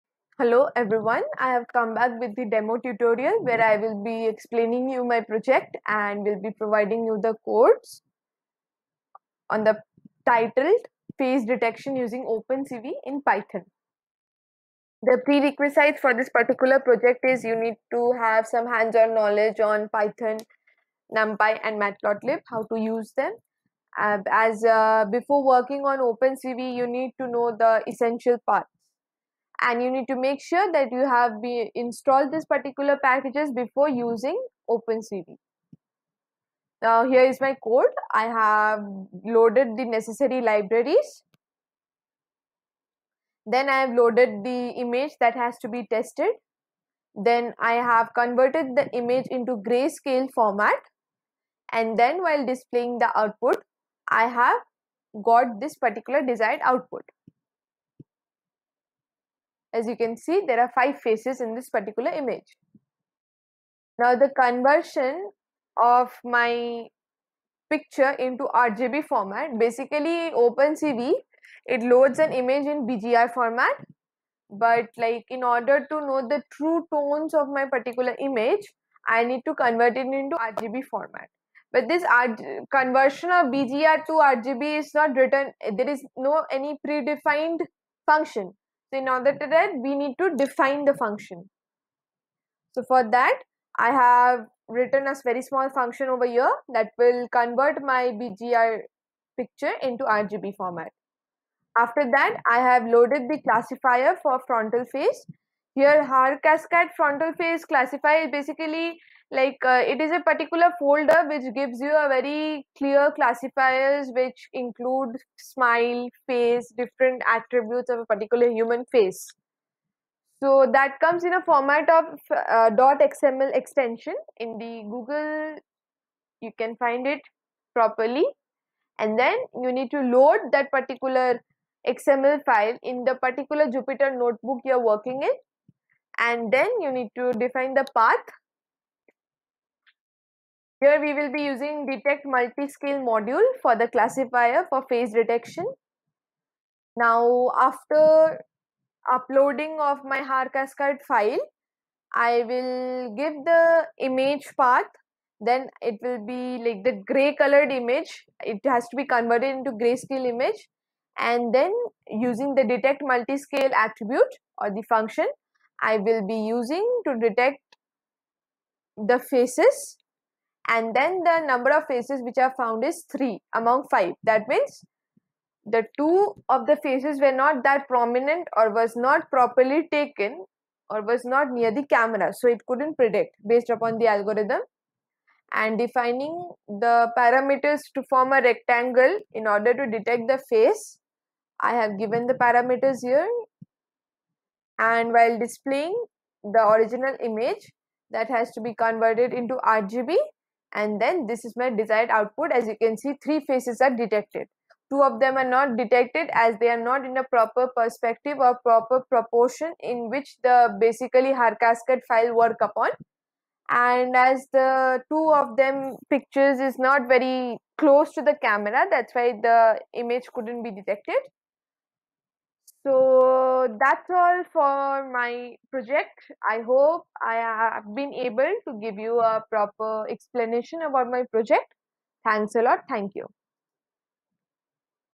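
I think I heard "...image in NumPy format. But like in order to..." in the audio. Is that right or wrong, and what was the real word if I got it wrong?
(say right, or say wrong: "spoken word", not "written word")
wrong: "BGR", not "NumPy".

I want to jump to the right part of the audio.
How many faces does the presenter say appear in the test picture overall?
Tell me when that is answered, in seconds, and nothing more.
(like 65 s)
60 s.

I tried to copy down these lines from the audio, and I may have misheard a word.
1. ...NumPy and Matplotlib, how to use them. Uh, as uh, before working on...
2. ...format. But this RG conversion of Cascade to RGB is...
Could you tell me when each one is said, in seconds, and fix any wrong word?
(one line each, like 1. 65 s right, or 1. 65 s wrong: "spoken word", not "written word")
1. 21 s right
2. 80 s wrong: "BGR", not "Cascade".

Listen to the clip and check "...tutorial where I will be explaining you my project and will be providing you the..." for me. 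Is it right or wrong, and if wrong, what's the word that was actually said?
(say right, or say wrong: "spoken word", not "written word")
right.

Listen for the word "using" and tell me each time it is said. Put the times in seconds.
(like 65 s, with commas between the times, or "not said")
11 s, 33 s, 141 s, 162 s, 166 s.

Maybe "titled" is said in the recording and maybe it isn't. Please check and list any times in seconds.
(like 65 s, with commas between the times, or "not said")
10 s.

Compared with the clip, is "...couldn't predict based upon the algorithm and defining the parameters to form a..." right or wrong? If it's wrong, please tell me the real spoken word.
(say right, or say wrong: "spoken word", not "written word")
right.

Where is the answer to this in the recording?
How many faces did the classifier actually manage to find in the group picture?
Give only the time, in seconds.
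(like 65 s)
173 s.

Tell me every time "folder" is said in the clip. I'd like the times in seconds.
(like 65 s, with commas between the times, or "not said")
110 s.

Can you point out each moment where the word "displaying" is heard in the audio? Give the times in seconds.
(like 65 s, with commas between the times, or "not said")
52 s, 195 s.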